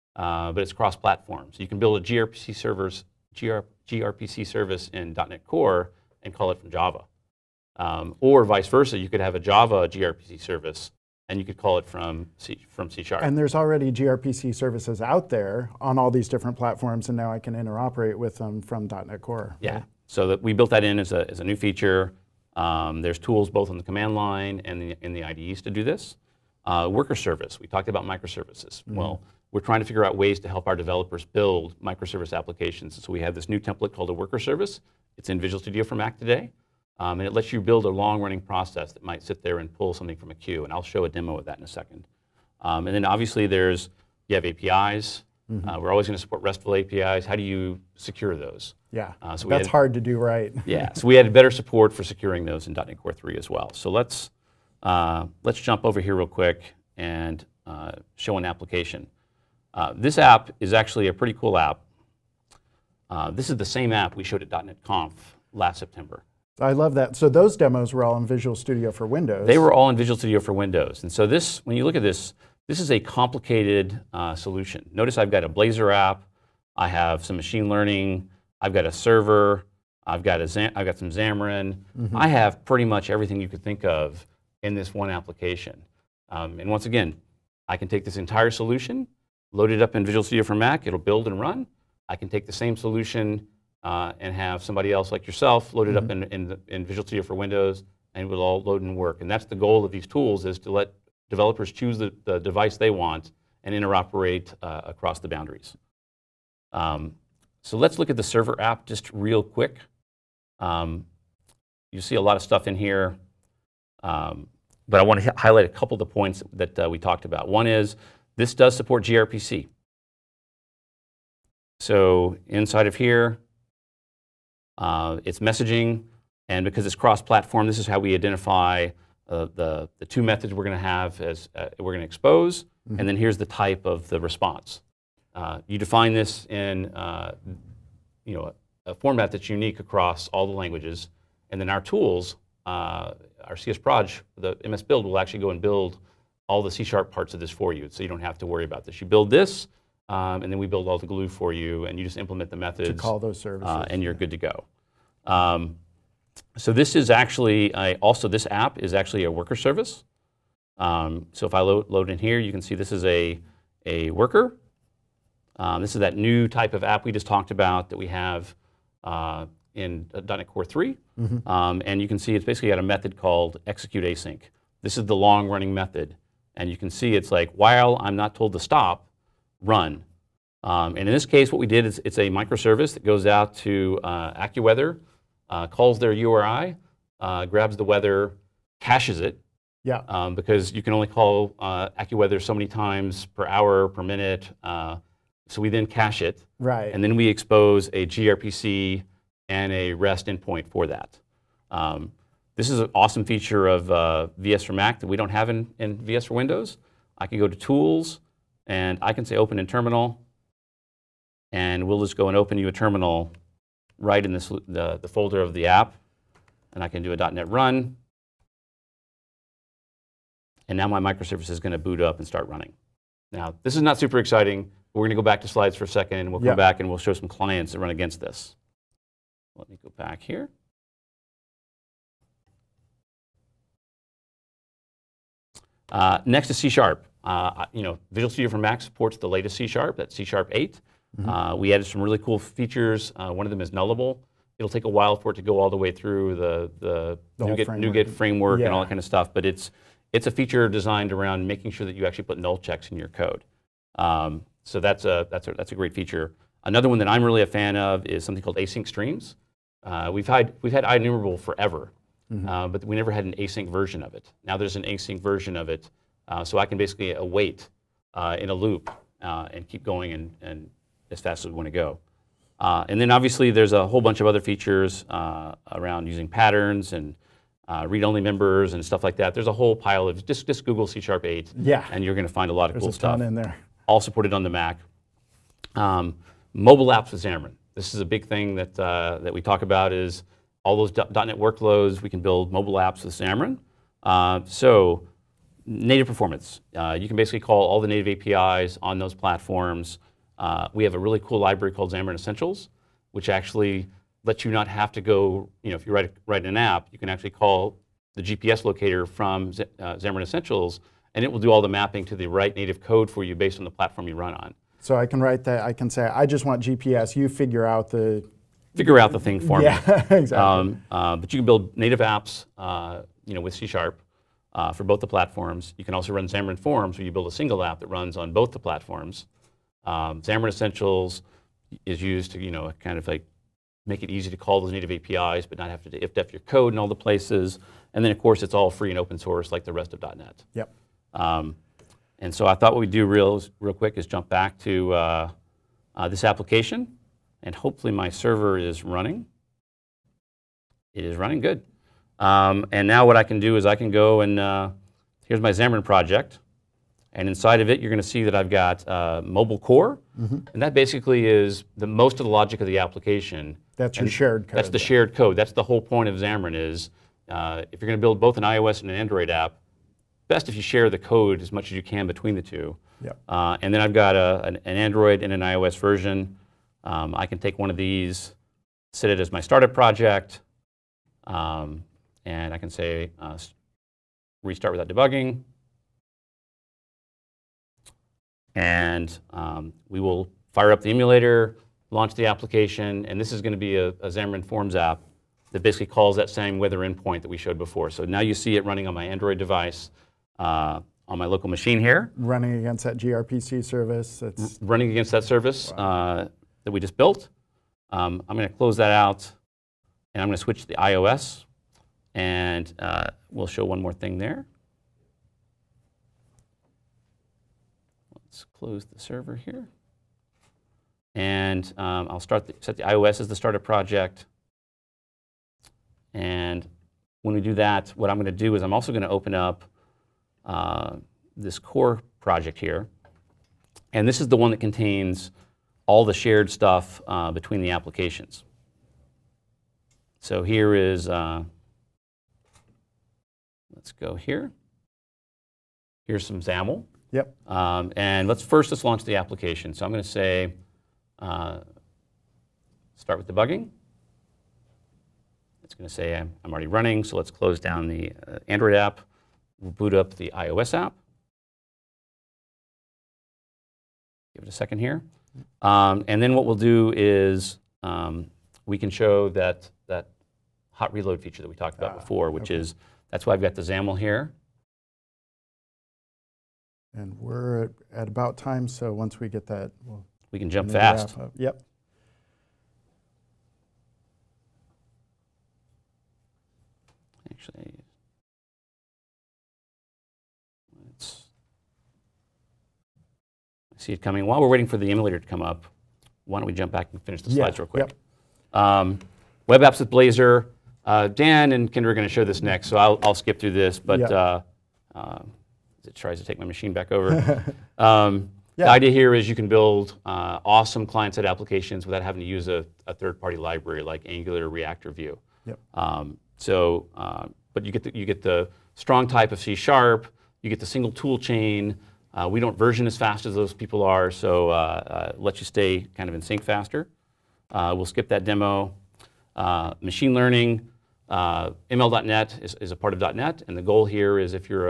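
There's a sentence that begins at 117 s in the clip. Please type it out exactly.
One is this does support gRPC.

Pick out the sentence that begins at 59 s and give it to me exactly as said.
Uh, this app is actually a pretty cool app.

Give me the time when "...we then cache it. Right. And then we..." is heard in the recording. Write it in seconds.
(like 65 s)
195 s.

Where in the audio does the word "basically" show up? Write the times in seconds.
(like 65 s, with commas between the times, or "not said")
172 s, 266 s, 297 s, 360 s, 395 s.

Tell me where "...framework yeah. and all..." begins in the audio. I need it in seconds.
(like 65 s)
248 s.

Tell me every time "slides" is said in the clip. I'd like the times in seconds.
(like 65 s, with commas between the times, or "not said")
225 s, 497 s.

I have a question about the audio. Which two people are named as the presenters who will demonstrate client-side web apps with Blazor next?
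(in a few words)
Dan and Kendra.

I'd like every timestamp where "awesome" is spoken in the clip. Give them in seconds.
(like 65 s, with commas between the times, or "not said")
202 s, 510 s.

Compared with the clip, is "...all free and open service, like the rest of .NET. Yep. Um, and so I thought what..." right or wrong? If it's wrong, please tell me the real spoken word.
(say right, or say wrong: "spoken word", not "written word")
wrong: "source", not "service".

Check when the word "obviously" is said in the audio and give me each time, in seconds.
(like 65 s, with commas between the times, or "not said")
43 s, 273 s.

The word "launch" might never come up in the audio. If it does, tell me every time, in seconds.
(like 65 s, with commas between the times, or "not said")
391 s, 448 s.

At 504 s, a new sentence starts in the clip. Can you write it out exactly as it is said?
uh, uh, it tries to take my machine back over.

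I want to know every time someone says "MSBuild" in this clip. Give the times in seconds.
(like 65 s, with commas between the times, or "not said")
144 s.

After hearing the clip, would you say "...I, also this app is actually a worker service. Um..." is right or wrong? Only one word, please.
right.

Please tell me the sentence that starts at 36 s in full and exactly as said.
Um, and it lets you build a long-running process that might sit there and pull something from a queue.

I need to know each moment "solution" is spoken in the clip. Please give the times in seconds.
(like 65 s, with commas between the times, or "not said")
74 s, 88 s, 92 s.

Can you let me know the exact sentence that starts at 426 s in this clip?
And when we do that, what I'm going to do is I'm also going to open up uh, this core project here.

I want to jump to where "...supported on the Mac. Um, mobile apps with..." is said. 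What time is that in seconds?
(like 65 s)
284 s.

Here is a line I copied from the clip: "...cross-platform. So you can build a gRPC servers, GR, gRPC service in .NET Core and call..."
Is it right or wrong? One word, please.
right.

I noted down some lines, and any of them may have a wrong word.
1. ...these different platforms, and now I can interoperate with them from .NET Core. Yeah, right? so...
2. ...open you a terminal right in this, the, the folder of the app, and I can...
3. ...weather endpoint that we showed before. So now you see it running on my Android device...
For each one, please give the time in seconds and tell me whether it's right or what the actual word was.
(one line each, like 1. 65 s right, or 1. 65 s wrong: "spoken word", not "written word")
1. 16 s right
2. 212 s right
3. 396 s right.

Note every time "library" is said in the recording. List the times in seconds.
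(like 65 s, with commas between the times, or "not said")
301 s, 513 s.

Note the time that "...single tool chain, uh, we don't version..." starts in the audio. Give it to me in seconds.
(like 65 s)
520 s.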